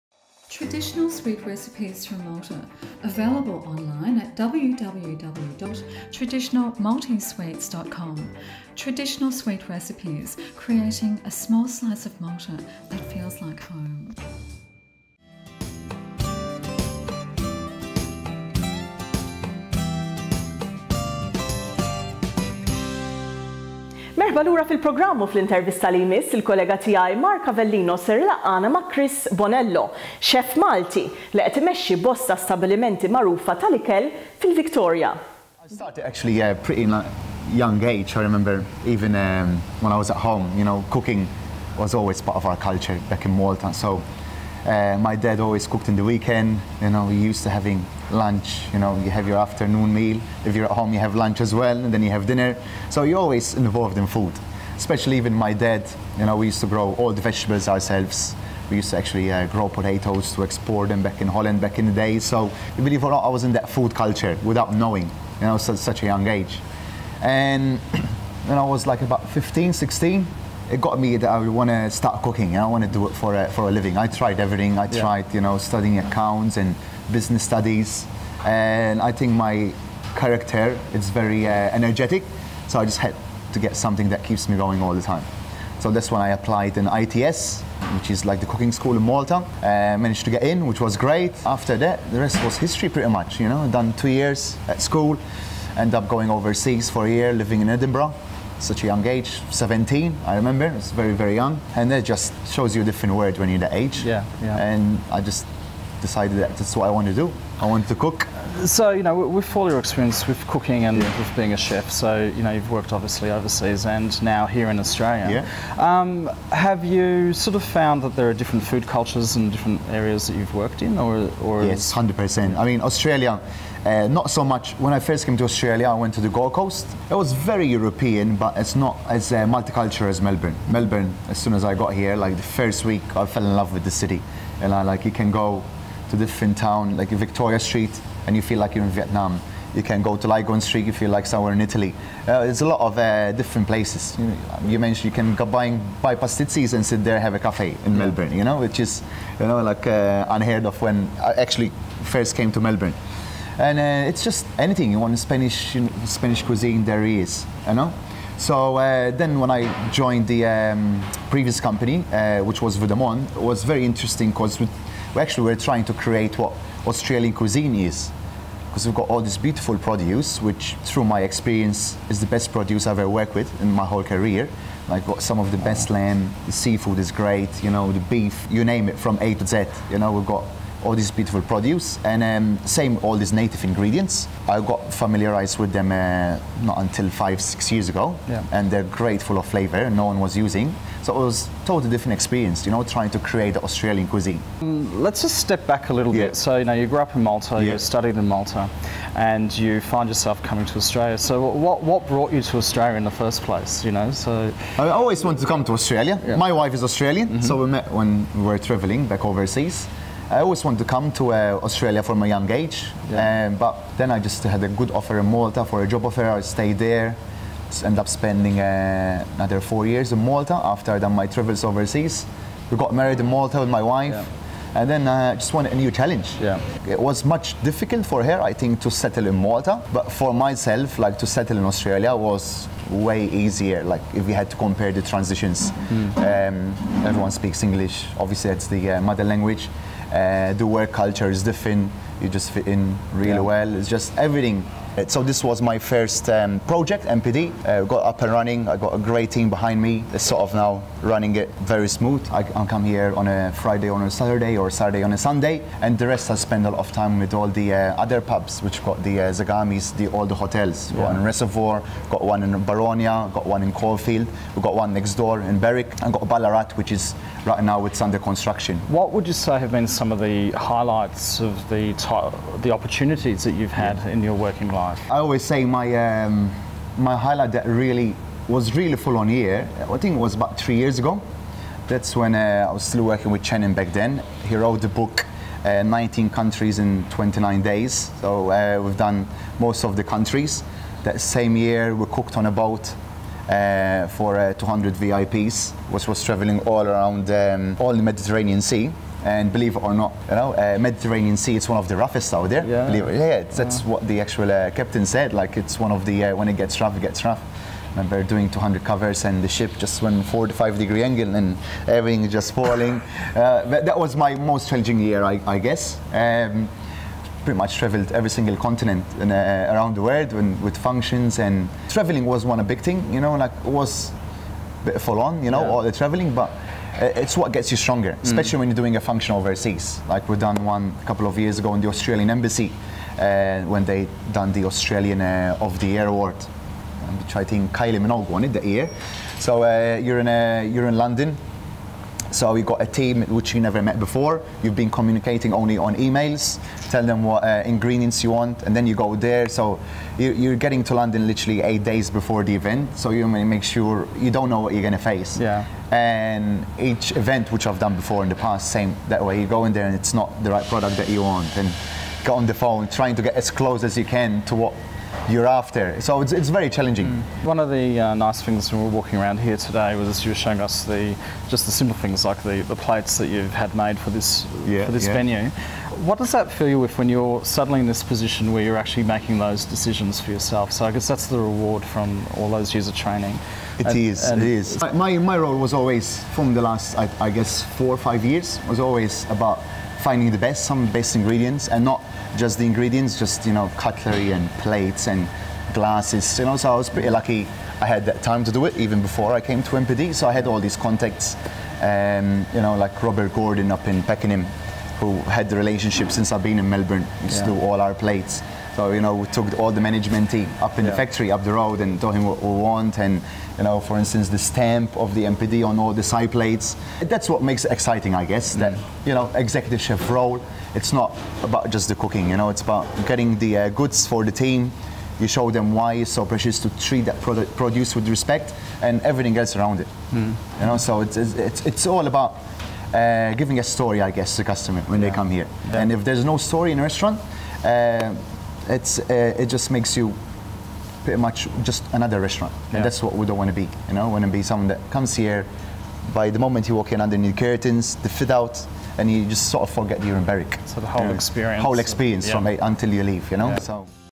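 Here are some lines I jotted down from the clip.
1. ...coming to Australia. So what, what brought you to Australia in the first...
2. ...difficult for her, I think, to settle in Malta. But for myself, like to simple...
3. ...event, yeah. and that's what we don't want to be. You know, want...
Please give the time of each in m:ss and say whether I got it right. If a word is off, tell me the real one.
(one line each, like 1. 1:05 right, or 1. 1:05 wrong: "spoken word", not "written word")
1. 3:20 right
2. 3:47 wrong: "settle", not "simple"
3. 7:22 wrong: "restaurant", not "event".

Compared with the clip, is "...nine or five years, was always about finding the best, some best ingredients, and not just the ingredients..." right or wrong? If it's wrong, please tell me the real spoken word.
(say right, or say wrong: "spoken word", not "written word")
wrong: "four", not "nine".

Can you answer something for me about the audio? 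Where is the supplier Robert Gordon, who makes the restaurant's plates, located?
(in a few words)
Pakenham.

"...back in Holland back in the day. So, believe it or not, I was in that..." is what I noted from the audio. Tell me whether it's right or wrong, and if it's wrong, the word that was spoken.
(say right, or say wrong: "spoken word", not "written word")
right.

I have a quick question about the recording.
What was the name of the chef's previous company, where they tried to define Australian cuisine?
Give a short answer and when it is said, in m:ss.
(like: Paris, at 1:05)
Vue de monde, at 2:42.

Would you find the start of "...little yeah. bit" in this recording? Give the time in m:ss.
3:15.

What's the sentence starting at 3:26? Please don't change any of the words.
My wife is Australian, mm -hmm.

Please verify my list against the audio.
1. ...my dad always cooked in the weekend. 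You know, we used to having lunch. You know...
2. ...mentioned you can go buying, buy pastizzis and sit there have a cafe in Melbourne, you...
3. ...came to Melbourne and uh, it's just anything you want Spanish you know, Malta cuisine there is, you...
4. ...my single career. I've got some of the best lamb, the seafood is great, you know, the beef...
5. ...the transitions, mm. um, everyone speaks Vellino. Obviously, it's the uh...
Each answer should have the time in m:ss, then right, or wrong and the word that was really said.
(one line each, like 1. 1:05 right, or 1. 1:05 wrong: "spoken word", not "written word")
1. 0:44 right
2. 2:24 right
3. 2:32 wrong: "Spanish", not "Malta"
4. 2:53 wrong: "whole", not "single"
5. 3:54 wrong: "English", not "Vellino".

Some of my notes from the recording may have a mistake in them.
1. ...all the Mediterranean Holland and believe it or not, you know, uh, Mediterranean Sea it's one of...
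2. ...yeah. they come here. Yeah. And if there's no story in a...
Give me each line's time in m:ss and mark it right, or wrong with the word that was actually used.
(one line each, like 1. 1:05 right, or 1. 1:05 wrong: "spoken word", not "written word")
1. 4:57 wrong: "Sea", not "Holland"
2. 7:15 right.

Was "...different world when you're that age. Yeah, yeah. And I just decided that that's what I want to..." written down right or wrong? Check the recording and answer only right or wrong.
right.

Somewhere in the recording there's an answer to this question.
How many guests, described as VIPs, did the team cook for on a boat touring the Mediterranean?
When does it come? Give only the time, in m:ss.
4:54.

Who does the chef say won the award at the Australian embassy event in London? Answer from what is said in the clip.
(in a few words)
Kylie Minogue.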